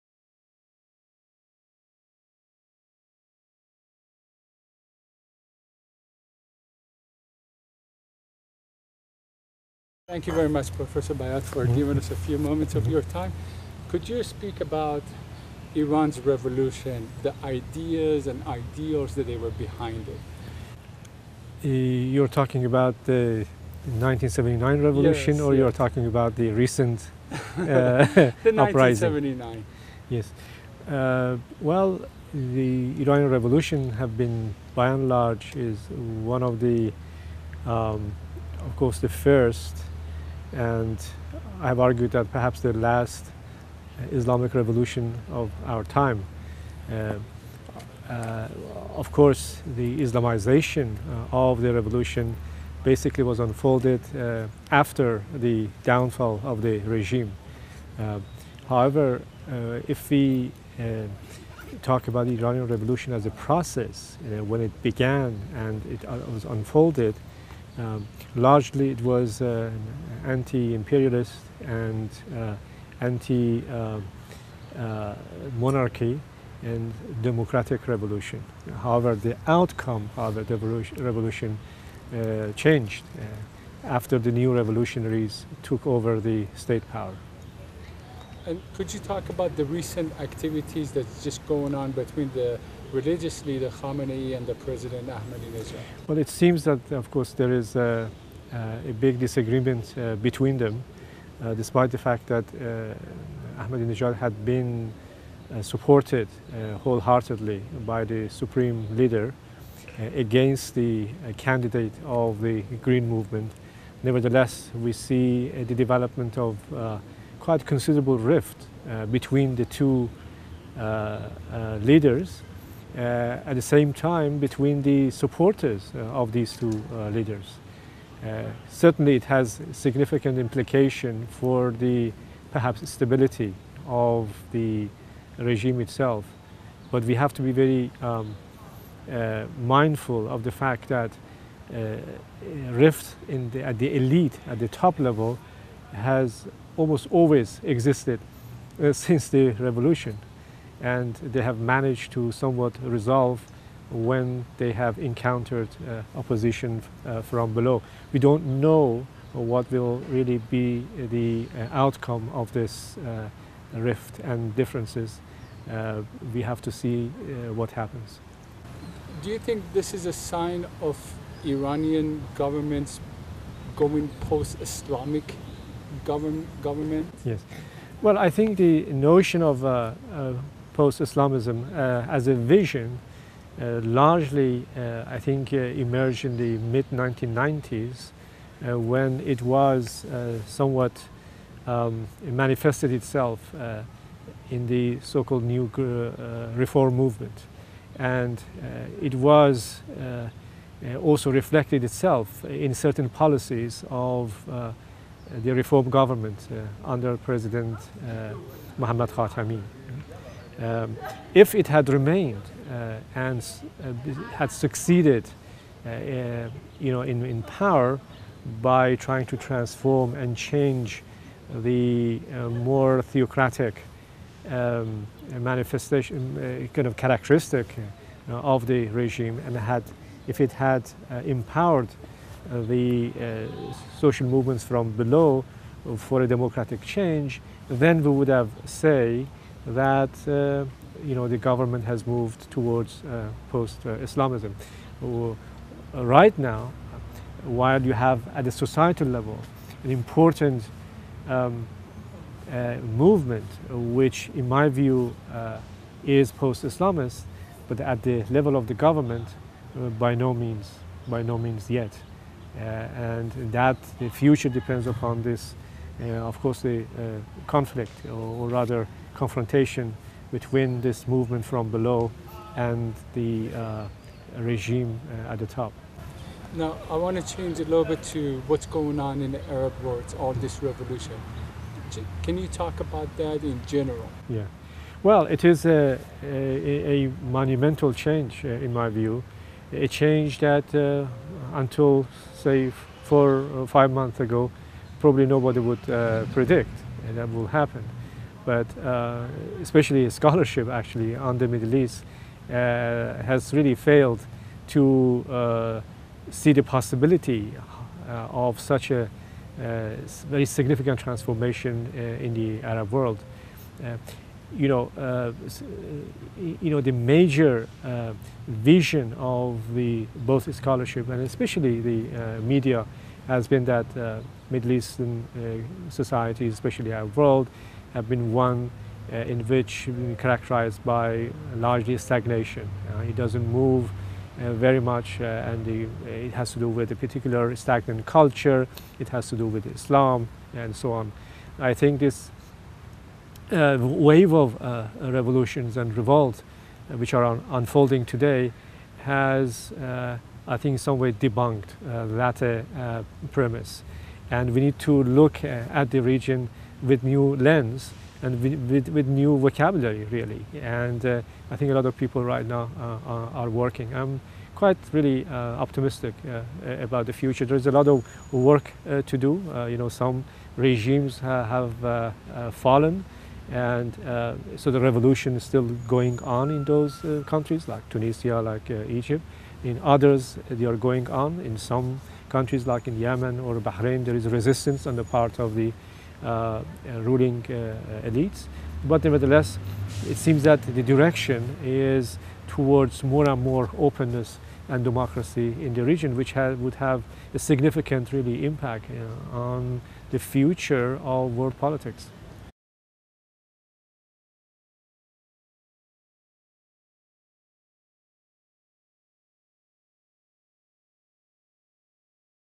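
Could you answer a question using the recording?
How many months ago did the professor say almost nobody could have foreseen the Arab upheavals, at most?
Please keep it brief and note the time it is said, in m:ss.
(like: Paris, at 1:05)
5, at 4:53.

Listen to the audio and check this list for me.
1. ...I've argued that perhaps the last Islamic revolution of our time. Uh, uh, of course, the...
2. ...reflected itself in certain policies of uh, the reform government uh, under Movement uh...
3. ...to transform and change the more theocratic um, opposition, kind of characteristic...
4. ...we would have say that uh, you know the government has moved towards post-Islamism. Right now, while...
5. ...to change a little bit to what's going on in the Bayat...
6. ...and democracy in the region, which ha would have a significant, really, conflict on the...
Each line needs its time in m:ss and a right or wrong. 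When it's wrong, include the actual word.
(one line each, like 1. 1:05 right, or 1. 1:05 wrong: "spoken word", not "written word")
1. 0:41 right
2. 3:21 wrong: "President", not "Movement"
3. 3:39 wrong: "manifestation", not "opposition"
4. 3:58 right
5. 4:37 wrong: "Arab", not "Bayat"
6. 6:34 wrong: "impact", not "conflict".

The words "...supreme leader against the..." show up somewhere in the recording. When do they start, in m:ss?
1:48.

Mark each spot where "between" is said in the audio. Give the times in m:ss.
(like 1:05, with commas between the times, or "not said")
1:31, 1:40, 1:59, 2:04, 4:30.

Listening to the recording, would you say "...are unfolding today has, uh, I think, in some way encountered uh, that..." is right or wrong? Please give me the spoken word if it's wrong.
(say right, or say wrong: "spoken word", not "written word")
wrong: "debunked", not "encountered".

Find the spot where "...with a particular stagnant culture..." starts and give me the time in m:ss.
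5:36.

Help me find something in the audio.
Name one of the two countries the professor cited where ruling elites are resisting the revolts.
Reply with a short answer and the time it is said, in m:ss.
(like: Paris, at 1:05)
Yemen or Bahrain, at 6:22.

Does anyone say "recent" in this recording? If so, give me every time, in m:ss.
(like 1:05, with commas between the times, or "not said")
0:26, 1:29.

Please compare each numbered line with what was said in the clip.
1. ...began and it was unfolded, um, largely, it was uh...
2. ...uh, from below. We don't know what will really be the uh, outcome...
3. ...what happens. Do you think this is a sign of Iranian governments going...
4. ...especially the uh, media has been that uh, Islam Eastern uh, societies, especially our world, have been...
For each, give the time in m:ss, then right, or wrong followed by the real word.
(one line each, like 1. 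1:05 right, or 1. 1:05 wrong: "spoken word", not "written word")
1. 1:04 right
2. 2:37 right
3. 2:47 right
4. 5:21 wrong: "Middle", not "Islam".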